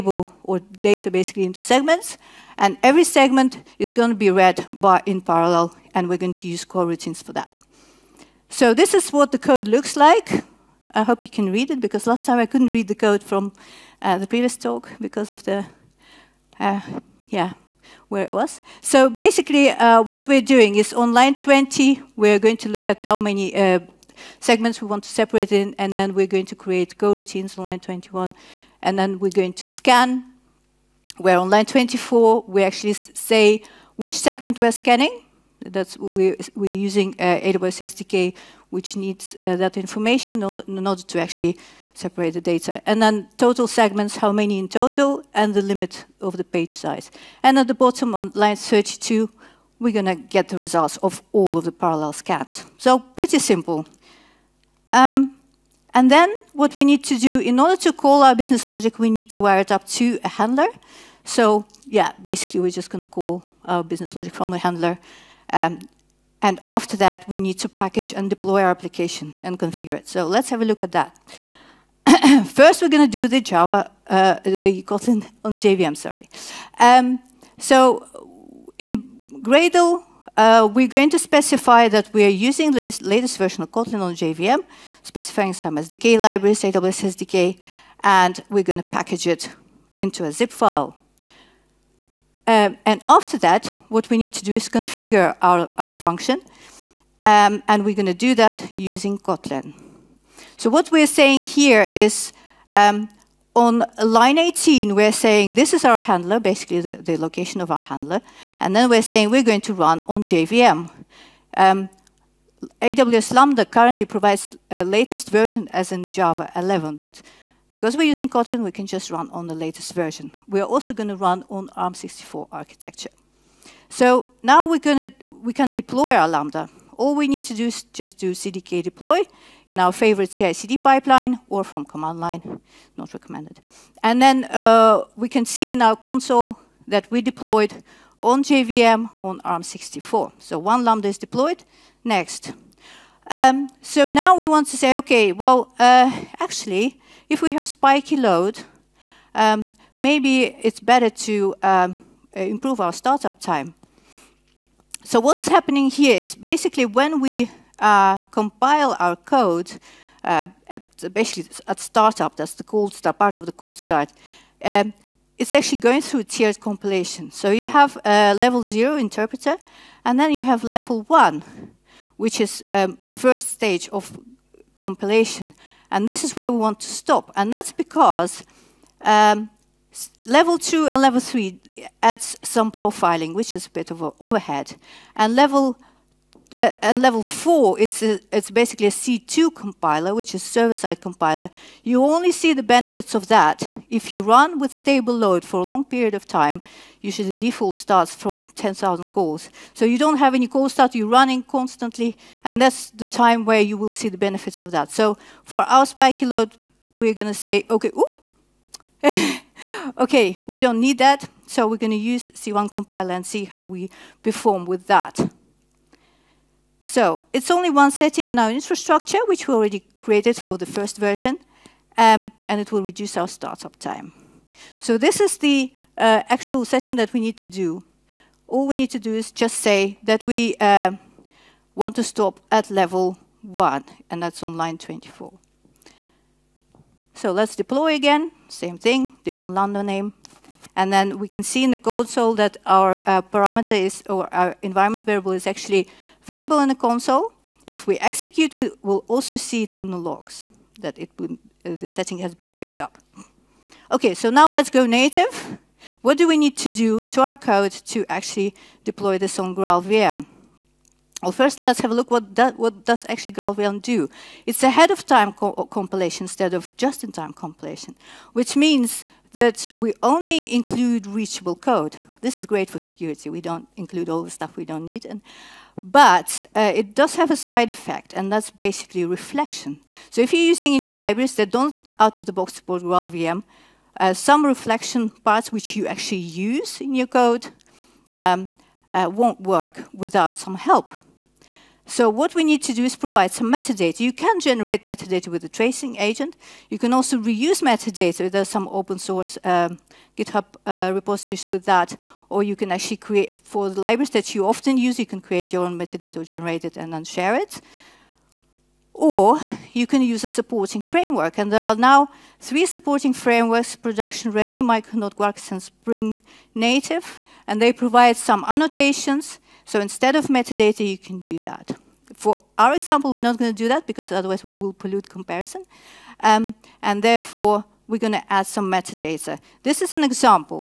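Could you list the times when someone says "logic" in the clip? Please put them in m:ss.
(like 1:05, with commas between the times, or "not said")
0:58, 1:04.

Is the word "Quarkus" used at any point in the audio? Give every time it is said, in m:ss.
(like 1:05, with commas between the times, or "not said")
5:15.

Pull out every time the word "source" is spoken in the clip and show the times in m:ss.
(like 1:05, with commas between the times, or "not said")
4:58.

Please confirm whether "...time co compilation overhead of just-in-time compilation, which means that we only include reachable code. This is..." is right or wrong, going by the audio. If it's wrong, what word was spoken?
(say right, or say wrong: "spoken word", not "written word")
wrong: "instead", not "overhead".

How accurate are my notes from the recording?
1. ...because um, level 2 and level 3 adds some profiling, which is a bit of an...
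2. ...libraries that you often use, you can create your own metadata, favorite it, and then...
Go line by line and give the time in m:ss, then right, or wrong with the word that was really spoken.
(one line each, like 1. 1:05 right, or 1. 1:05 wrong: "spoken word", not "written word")
1. 2:57 right
2. 5:03 wrong: "generate", not "favorite".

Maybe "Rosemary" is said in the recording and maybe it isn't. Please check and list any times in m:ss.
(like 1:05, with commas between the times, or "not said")
not said.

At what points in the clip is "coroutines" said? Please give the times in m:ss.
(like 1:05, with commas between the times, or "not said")
0:06, 0:26.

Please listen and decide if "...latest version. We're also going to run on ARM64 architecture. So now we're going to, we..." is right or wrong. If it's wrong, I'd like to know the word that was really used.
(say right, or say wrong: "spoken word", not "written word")
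right.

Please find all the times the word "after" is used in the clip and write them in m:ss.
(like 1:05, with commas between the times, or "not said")
1:06, 1:33.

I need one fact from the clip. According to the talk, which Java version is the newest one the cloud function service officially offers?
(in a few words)
Java 11.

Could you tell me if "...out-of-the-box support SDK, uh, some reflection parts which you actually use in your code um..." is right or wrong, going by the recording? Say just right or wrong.
wrong.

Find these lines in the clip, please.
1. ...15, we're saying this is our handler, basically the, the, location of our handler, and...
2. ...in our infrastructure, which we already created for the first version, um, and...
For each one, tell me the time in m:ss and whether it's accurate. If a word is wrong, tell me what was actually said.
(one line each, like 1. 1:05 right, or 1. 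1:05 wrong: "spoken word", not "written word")
1. 1:44 wrong: "18", not "15"
2. 3:38 right.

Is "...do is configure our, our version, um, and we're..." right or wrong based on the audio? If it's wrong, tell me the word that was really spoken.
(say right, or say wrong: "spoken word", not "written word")
wrong: "function", not "version".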